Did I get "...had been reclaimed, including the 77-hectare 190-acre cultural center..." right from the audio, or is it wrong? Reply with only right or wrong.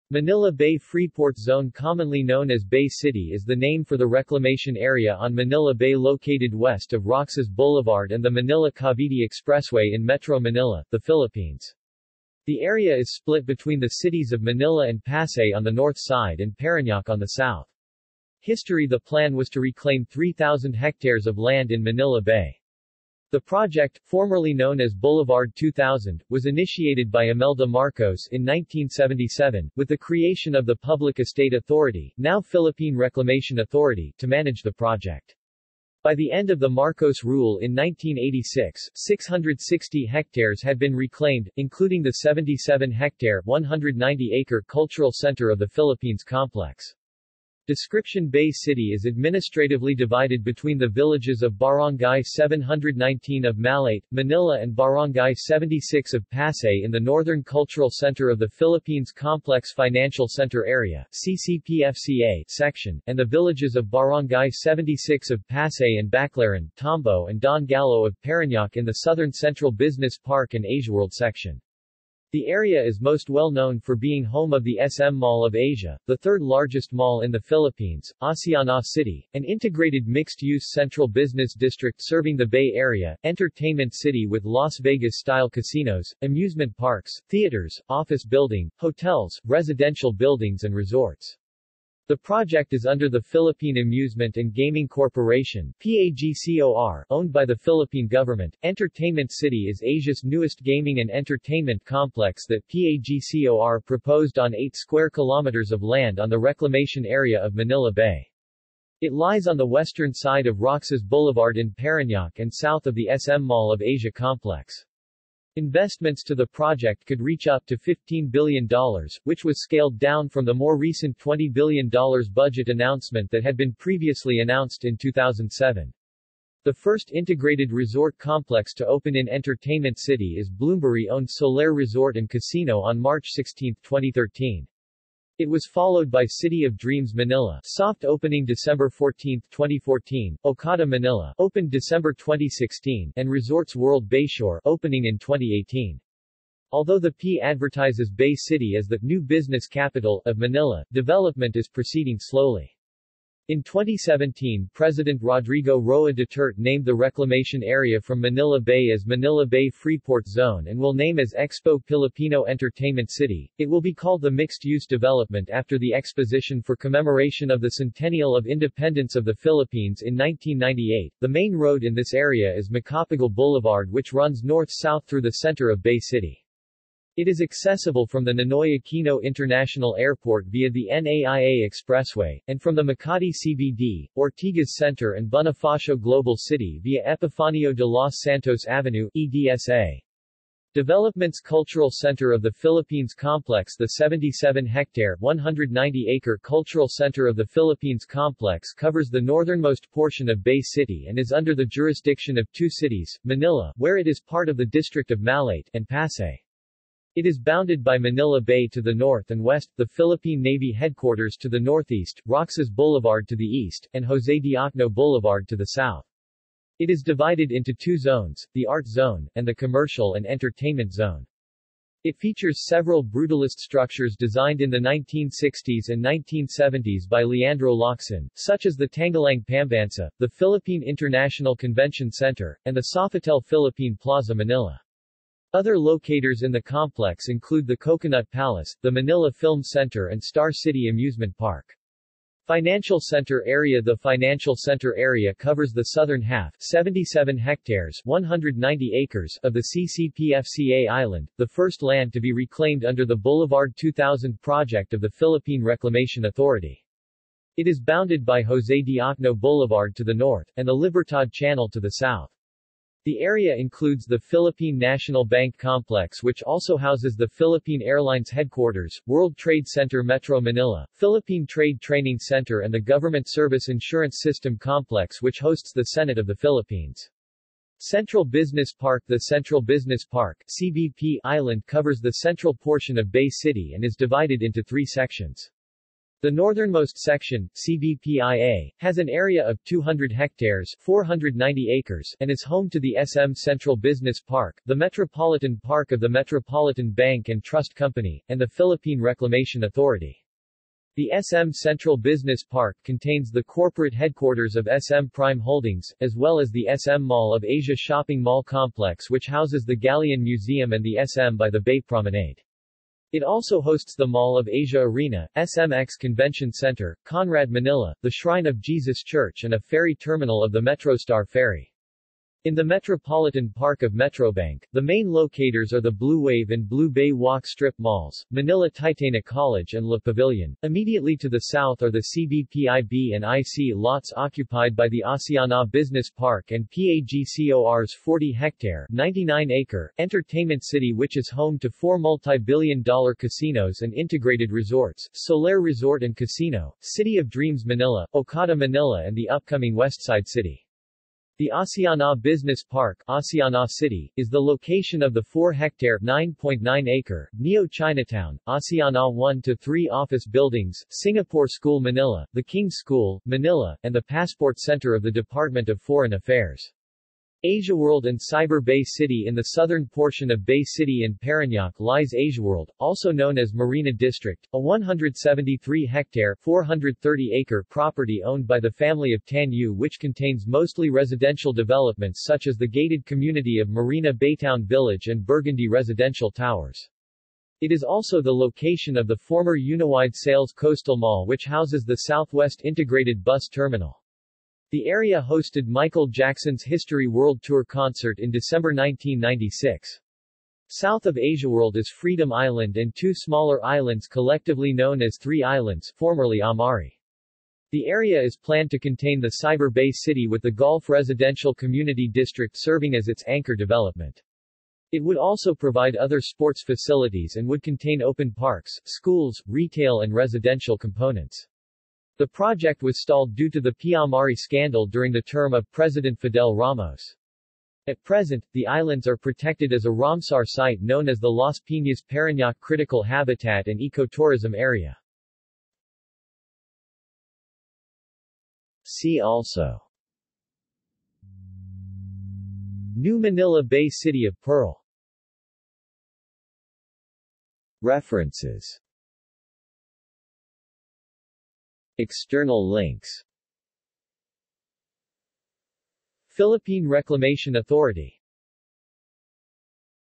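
right.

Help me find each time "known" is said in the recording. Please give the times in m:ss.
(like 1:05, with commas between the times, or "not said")
0:02, 0:24, 1:13, 6:13, 6:44, 7:10.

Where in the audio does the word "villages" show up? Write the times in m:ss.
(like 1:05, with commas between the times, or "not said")
0:50, 1:03, 6:24.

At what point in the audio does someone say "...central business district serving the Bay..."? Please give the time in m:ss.
1:20.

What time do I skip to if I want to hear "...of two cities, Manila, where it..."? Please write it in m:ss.
3:22.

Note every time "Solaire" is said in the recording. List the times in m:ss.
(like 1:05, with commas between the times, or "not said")
2:11, 5:45.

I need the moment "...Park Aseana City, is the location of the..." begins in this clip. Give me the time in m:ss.
5:52.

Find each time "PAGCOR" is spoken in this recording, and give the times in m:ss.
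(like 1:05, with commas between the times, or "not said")
1:35, 1:42, 5:36.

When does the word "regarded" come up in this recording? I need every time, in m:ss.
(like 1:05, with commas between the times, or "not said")
not said.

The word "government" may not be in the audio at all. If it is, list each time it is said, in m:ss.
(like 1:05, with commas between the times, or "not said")
1:38, 4:32.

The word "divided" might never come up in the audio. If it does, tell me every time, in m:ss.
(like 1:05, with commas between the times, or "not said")
0:49, 3:37, 4:43.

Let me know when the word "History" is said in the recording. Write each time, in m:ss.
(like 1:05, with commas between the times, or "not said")
0:18, 6:36.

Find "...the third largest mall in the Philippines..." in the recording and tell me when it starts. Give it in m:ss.
1:16.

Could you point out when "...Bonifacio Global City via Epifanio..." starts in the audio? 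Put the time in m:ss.
3:05.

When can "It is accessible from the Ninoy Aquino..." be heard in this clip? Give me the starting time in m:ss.
2:57.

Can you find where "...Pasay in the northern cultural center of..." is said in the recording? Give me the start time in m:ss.
0:56.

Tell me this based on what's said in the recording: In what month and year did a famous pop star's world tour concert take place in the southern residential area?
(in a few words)
December 1996.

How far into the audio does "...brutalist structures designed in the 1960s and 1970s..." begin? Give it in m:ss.
3:43.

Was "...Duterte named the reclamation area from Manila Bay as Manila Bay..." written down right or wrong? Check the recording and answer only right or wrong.
right.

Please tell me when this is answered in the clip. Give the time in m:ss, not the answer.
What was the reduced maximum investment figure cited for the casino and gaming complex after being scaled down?
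1:57.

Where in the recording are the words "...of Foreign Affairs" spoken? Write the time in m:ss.
6:05.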